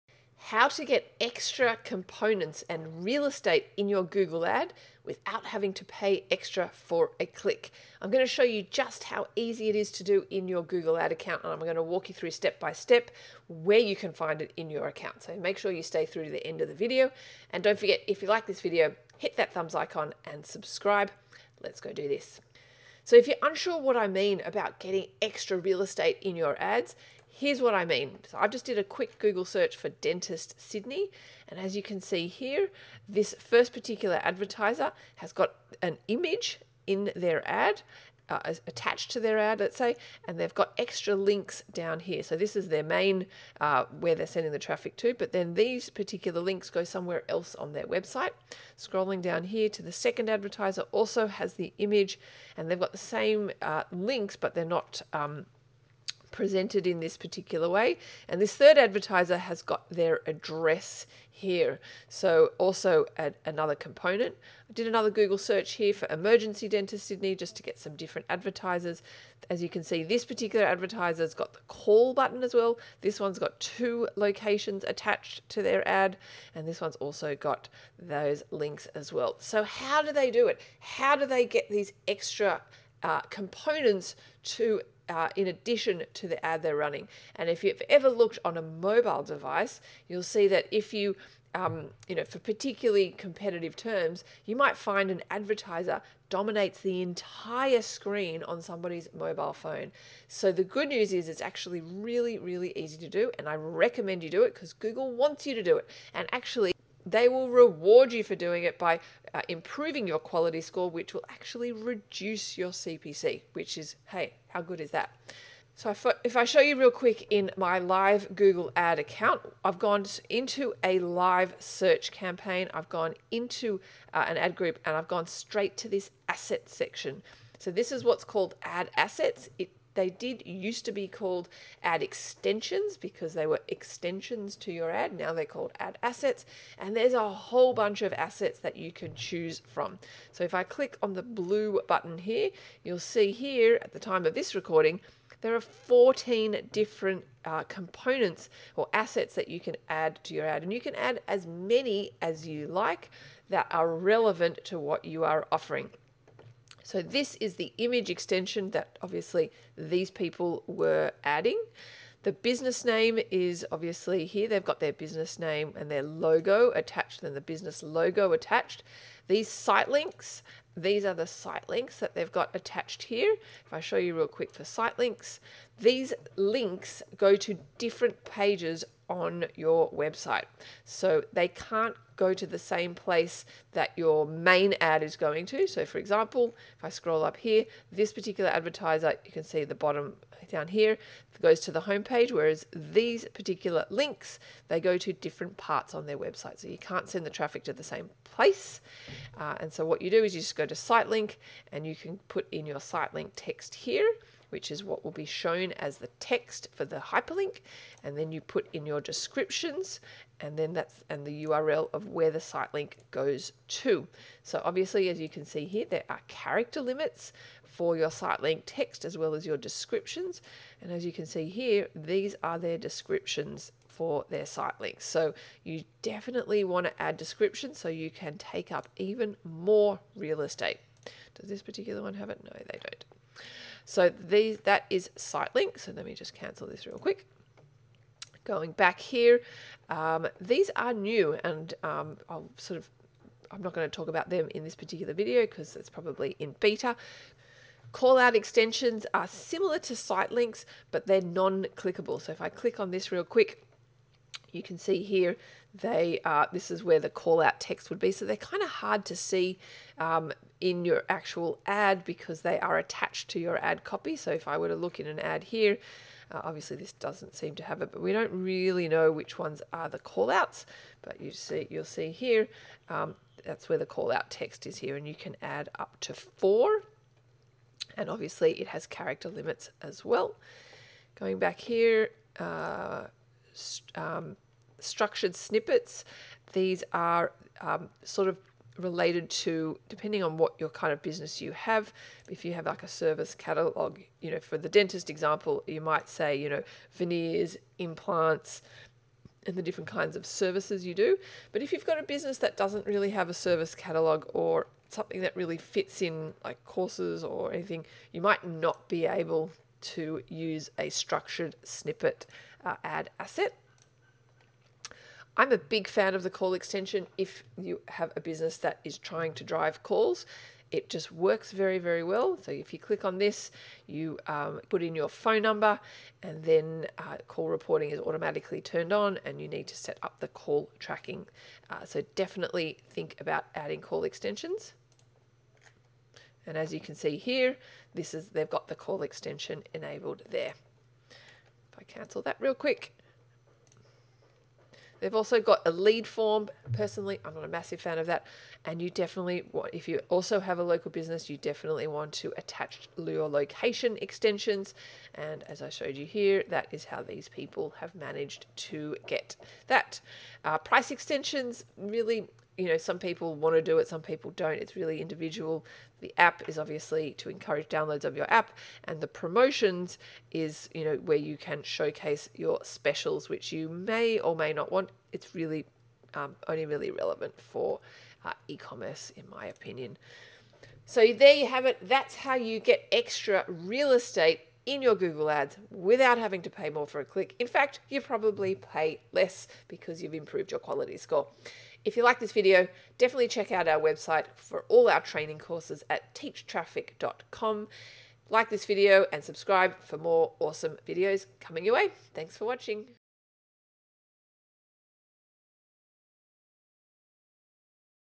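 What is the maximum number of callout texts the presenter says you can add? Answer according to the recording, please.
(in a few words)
4.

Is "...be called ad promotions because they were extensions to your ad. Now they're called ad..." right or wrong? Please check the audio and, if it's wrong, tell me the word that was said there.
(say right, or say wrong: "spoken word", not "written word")
wrong: "extensions", not "promotions".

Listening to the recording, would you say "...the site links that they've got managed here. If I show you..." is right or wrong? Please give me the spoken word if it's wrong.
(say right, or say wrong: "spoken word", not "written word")
wrong: "attached", not "managed".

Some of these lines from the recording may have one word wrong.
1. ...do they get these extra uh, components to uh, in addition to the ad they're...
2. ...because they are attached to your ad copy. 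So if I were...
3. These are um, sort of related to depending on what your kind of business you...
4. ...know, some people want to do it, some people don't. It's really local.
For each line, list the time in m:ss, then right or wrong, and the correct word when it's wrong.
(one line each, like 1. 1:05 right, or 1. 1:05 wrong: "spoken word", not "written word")
1. 1:21 right
2. 4:22 right
3. 4:46 right
4. 6:02 wrong: "individual", not "local".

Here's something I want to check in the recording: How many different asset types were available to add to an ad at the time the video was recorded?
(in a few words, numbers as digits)
14.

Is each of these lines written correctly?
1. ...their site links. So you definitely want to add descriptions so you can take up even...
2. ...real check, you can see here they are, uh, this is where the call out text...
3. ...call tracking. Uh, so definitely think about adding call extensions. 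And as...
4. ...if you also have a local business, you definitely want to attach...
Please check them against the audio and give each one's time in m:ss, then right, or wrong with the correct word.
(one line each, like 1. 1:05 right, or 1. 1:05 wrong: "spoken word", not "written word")
1. 3:44 right
2. 4:13 wrong: "quick", not "check"
3. 5:30 right
4. 5:49 right.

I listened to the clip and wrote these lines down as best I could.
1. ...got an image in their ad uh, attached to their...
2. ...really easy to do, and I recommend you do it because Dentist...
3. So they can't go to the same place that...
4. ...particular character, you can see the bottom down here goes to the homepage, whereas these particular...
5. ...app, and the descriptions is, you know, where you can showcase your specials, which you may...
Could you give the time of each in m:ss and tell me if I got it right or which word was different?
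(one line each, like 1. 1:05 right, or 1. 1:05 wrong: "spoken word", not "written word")
1. 0:35 right
2. 1:42 wrong: "Google", not "Dentist"
3. 3:00 right
4. 3:08 wrong: "advertiser", not "character"
5. 6:08 wrong: "promotions", not "descriptions".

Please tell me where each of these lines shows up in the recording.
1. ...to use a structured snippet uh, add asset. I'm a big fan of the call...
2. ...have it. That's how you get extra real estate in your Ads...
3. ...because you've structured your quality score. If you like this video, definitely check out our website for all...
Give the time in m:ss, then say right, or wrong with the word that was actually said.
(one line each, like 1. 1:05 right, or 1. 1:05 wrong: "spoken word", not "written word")
1. 5:09 right
2. 6:21 wrong: "Google", not "Ads"
3. 6:29 wrong: "improved", not "structured".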